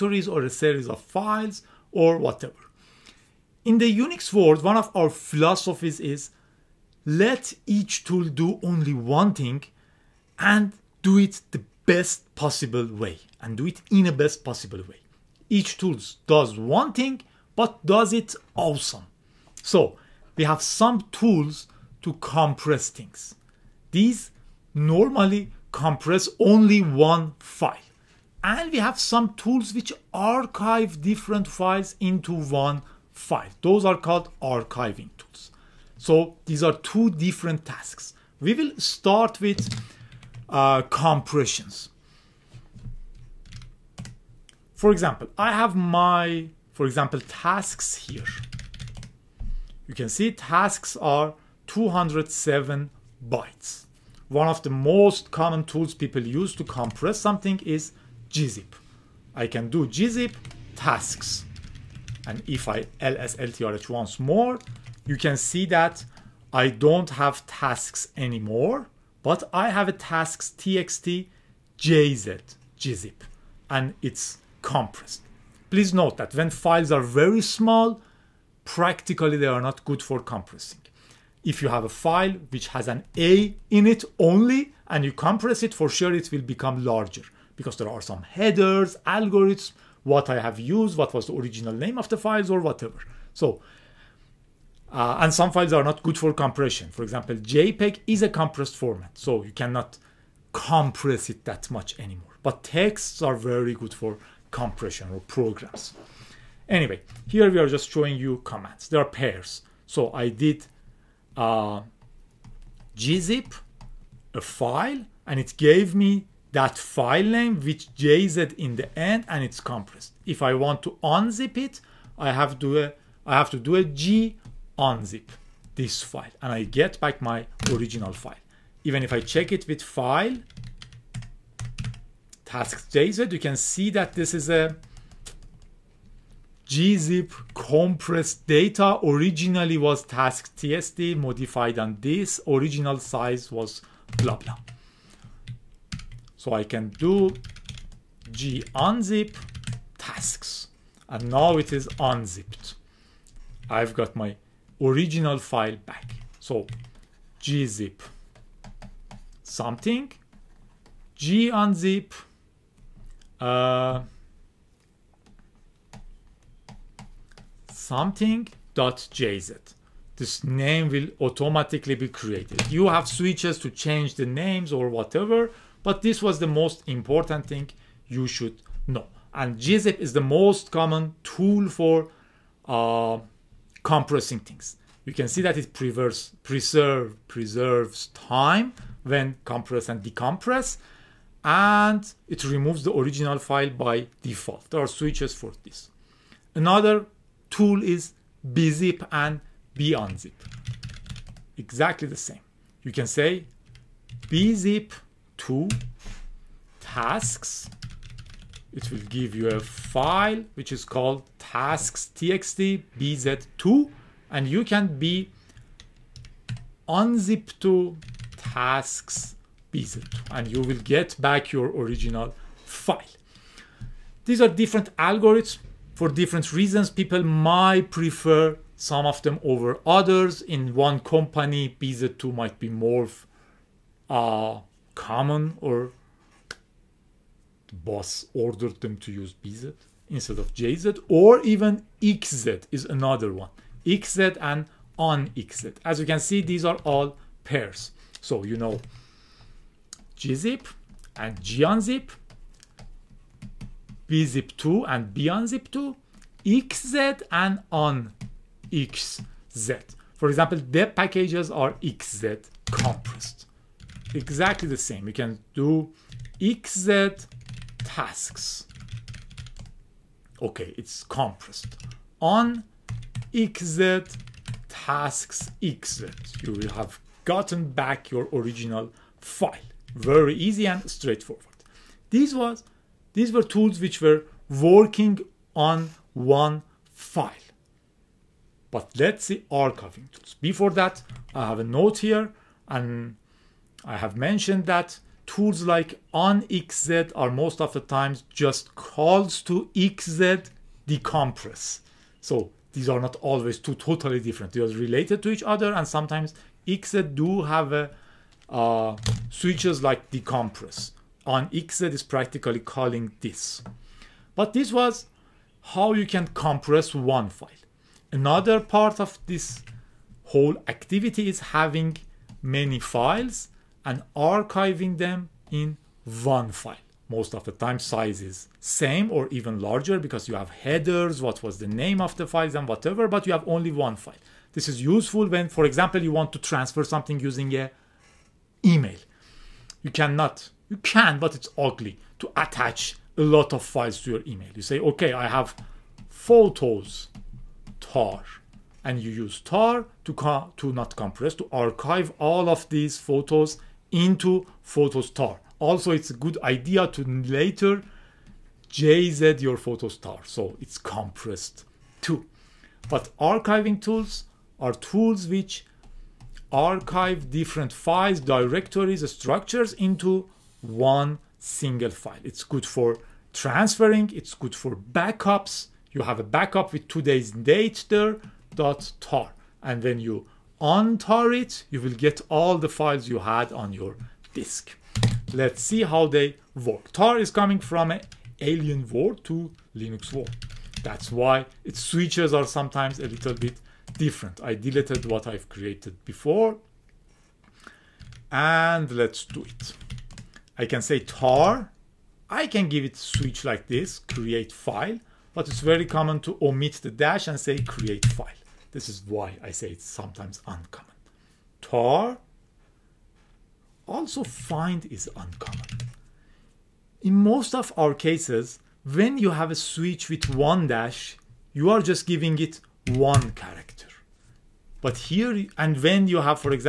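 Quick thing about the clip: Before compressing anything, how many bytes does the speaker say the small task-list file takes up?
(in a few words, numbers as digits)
207.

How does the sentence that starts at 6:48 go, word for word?
This is why I say it's sometimes uncommon.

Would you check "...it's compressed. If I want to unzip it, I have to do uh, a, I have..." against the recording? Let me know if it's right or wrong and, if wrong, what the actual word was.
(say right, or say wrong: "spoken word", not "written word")
right.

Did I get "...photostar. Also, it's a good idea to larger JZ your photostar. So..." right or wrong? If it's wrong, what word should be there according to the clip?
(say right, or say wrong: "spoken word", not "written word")
wrong: "later", not "larger".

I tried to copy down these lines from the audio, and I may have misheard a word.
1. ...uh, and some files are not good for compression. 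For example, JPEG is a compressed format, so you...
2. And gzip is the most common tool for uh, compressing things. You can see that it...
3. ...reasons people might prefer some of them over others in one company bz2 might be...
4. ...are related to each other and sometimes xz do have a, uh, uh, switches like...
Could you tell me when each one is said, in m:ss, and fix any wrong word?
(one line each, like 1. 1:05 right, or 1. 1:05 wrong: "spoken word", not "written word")
1. 1:34 right
2. 2:59 right
3. 3:46 right
4. 5:04 right.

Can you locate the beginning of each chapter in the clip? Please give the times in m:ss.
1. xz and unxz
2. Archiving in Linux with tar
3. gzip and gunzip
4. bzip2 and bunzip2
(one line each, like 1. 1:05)
1. 4:01
2. 5:16
3. 0:41
4. 3:16.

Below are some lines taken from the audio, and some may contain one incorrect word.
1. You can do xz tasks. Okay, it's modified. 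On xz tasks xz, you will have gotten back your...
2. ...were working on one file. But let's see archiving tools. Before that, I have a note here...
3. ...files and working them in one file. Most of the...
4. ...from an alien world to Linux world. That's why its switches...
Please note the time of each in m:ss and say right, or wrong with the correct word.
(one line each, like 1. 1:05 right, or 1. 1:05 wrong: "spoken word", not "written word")
1. 4:25 wrong: "compressed", not "modified"
2. 4:44 right
3. 5:22 wrong: "archiving", not "working"
4. 6:27 right.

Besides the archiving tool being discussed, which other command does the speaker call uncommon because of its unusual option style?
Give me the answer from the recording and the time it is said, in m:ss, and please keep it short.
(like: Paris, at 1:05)
find, at 6:54.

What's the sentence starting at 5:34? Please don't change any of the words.
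This is useful when, for example, you want to transfer something using a email.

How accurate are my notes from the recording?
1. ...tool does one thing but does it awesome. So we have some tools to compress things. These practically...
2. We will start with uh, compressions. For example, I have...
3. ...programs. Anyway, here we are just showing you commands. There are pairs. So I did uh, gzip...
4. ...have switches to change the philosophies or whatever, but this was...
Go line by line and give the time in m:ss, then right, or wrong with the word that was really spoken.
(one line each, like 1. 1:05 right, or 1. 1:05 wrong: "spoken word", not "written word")
1. 0:15 wrong: "normally", not "practically"
2. 0:38 right
3. 1:45 right
4. 2:52 wrong: "names", not "philosophies".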